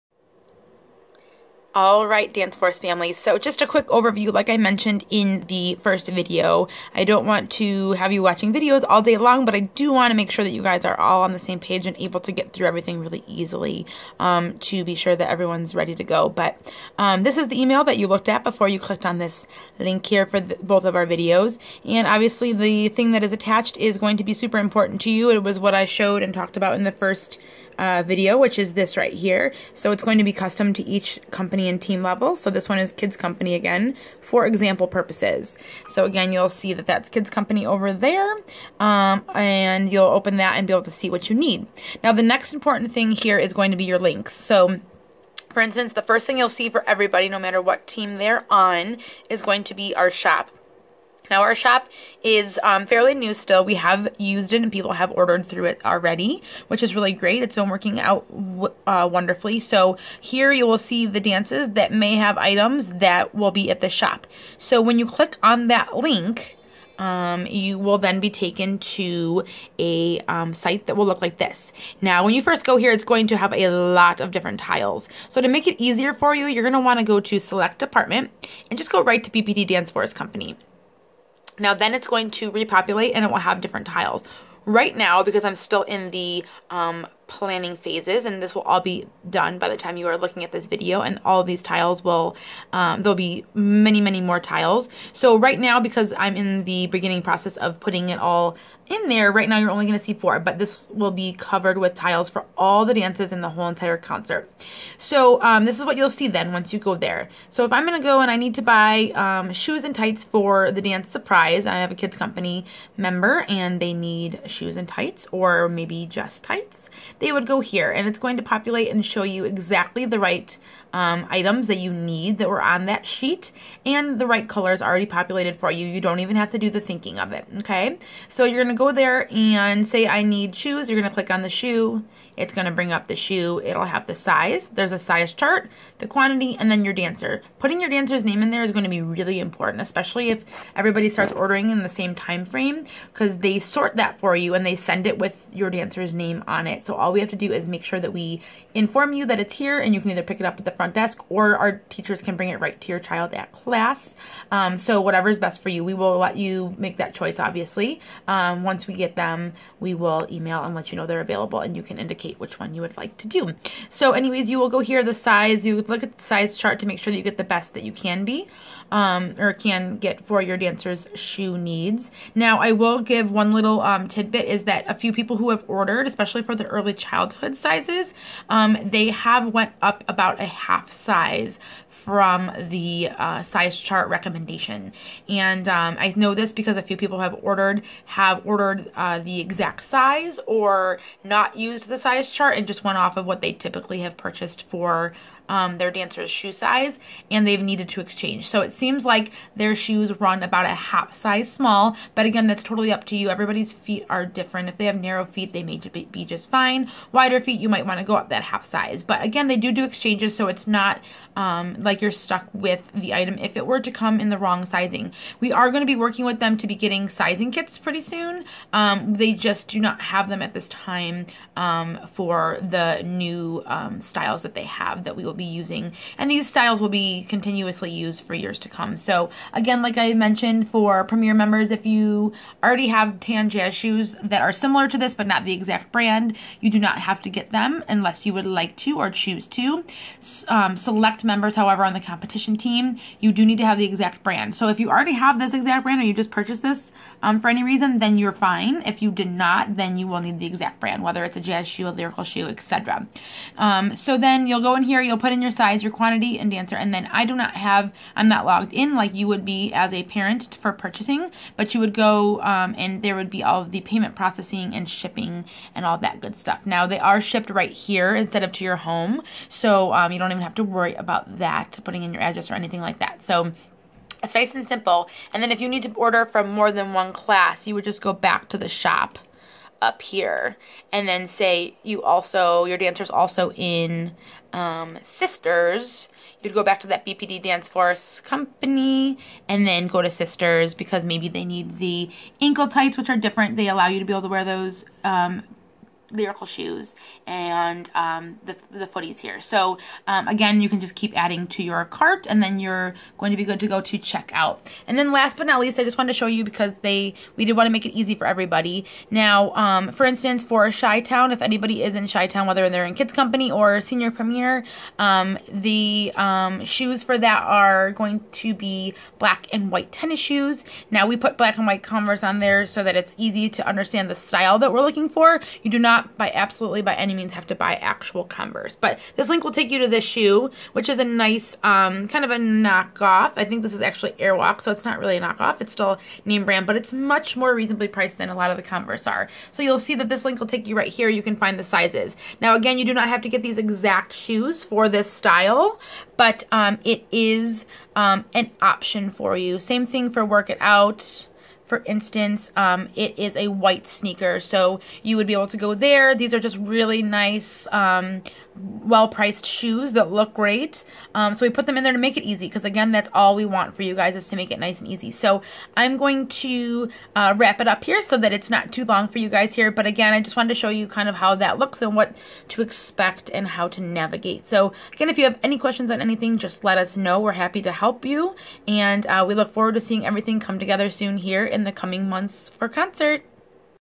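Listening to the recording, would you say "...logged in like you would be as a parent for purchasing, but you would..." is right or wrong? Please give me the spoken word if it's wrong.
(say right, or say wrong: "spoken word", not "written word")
right.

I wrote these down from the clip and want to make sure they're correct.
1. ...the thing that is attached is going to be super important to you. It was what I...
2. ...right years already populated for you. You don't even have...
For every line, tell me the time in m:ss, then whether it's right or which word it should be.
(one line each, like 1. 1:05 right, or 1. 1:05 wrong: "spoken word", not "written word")
1. 0:22 right
2. 2:04 wrong: "colors", not "years".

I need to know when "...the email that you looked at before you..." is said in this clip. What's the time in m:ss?
0:17.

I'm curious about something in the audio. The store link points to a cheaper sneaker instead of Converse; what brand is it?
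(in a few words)
Airwalk.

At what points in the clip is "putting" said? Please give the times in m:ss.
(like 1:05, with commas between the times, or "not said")
1:37, 2:17, 4:31.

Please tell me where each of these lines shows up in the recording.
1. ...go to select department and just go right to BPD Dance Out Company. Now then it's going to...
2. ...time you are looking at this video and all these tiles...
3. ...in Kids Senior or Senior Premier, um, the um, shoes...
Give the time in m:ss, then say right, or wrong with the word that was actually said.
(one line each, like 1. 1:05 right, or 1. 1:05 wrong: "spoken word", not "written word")
1. 1:17 wrong: "Force", not "Out"
2. 1:29 right
3. 5:12 wrong: "Company", not "Senior".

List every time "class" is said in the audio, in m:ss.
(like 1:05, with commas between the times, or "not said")
2:33, 4:37.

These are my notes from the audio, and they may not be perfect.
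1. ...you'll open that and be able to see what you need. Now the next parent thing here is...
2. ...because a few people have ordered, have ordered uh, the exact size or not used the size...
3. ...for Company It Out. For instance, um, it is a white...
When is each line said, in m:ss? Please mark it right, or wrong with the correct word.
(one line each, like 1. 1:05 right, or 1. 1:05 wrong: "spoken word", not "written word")
1. 0:39 wrong: "important", not "parent"
2. 3:06 right
3. 5:50 wrong: "Work", not "Company".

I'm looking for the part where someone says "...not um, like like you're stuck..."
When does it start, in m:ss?
3:30.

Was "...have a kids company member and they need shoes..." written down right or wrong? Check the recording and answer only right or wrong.
right.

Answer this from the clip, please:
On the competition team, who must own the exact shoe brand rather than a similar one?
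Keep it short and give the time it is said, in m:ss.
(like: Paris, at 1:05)
Select members, at 4:00.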